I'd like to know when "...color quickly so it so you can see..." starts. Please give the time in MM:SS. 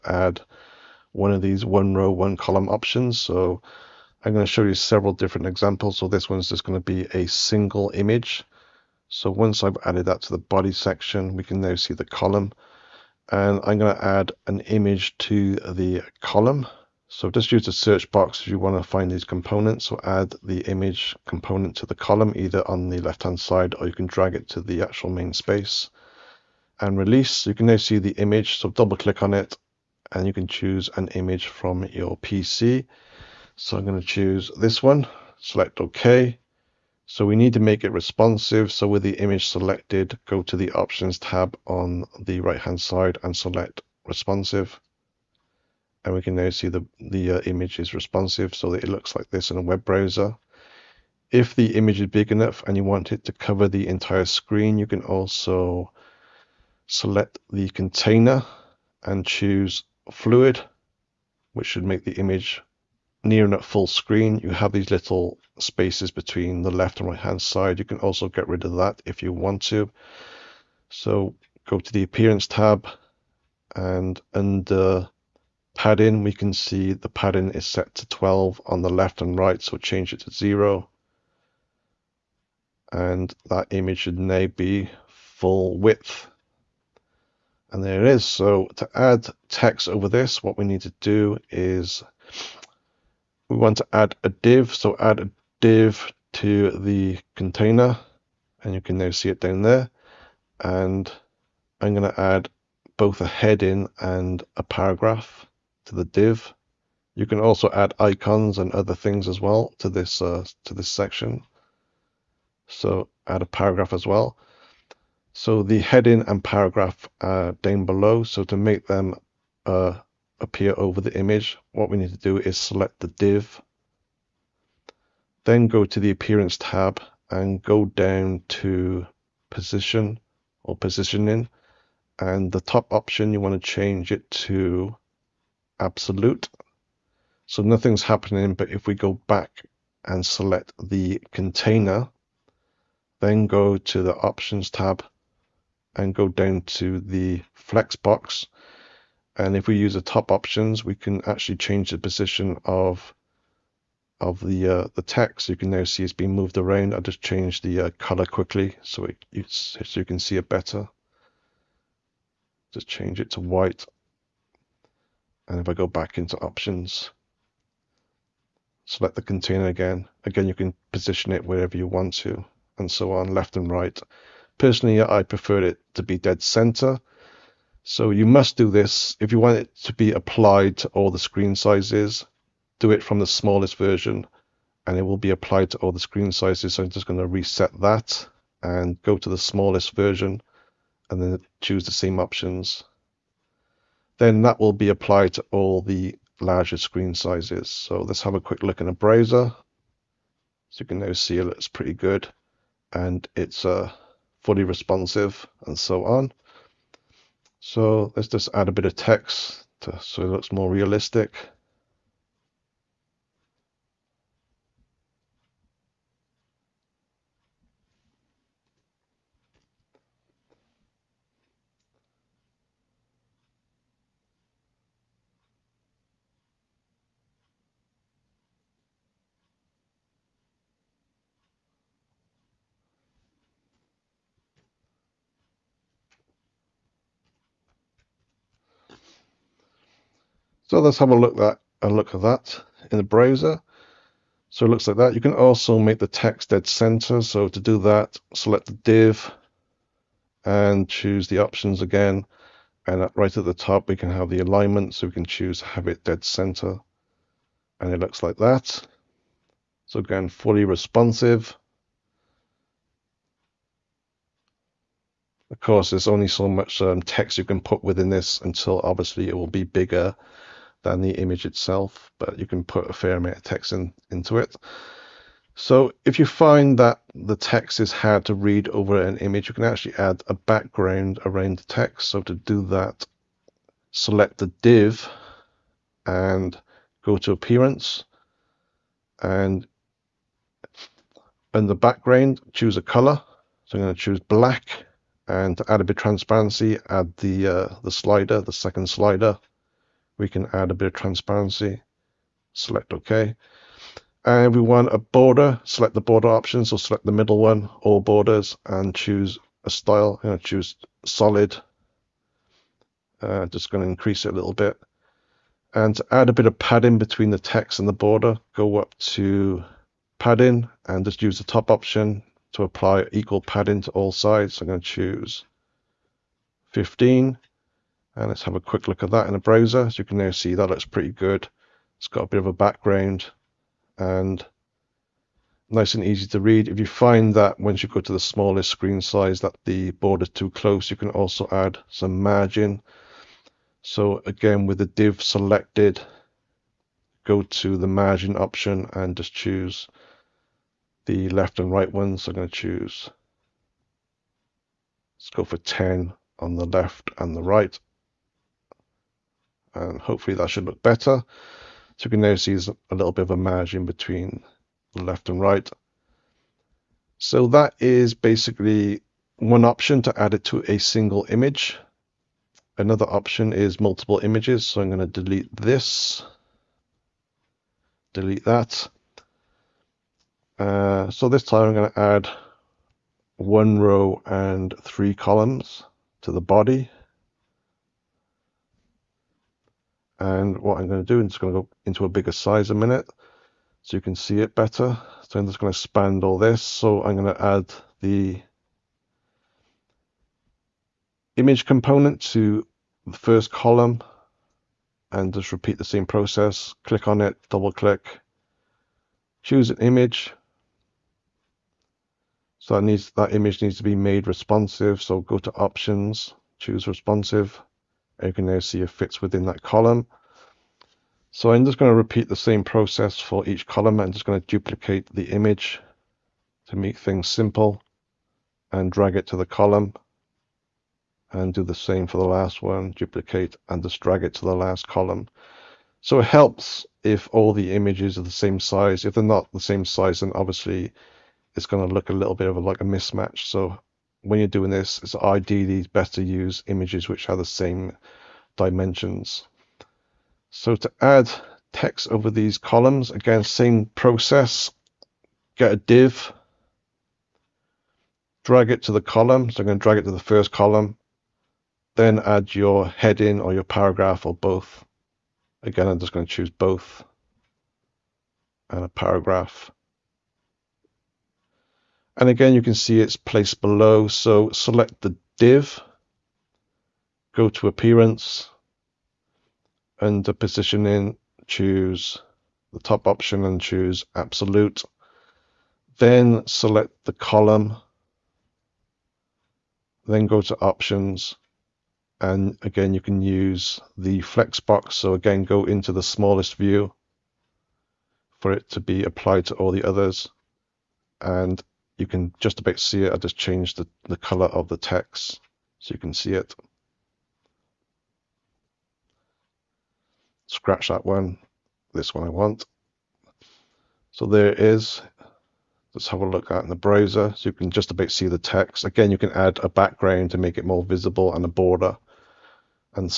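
02:37.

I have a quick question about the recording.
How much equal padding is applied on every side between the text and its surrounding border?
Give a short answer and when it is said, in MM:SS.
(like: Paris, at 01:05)
15, at 05:26.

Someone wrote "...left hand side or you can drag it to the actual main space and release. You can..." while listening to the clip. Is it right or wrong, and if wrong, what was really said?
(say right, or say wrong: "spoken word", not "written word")
right.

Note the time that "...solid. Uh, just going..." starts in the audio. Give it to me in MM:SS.
05:11.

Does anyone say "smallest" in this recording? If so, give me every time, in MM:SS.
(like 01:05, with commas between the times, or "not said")
03:03, 03:09, 05:38, 08:16.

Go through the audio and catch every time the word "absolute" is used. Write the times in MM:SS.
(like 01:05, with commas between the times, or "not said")
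02:15, 08:04.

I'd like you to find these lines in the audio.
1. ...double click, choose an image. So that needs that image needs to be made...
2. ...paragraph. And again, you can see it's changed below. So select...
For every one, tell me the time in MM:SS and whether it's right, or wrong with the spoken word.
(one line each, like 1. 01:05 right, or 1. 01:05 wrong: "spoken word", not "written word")
1. 06:47 right
2. 07:48 wrong: "placed", not "changed".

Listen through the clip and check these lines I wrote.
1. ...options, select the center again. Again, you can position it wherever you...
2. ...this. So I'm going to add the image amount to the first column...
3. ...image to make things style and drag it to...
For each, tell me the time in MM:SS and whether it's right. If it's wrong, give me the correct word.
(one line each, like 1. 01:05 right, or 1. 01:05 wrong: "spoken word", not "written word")
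1. 02:46 wrong: "container", not "center"
2. 06:36 wrong: "component", not "amount"
3. 07:05 wrong: "simple", not "style".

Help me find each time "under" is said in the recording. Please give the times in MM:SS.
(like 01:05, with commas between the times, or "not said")
01:14, 07:59.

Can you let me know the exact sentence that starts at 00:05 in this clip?
So this one's just going to be a single image.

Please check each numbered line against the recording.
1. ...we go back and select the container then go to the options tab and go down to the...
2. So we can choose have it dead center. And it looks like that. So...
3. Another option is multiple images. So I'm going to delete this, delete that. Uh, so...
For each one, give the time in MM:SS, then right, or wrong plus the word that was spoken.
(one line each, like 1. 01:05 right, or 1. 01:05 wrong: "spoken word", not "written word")
1. 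02:18 right
2. 04:14 right
3. 06:12 right.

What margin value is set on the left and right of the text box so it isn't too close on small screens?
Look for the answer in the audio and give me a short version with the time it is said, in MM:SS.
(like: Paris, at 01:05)
10, at 05:55.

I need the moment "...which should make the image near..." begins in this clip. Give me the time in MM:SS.
01:01.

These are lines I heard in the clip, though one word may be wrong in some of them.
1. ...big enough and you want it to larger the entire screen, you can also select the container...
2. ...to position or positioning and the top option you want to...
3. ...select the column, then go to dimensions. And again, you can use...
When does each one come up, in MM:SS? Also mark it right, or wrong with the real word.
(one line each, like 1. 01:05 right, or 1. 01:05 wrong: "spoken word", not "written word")
1. 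00:52 wrong: "cover", not "larger"
2. 02:08 right
3. 08:06 wrong: "options", not "dimensions".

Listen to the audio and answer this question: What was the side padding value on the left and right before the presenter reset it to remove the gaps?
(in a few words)
12.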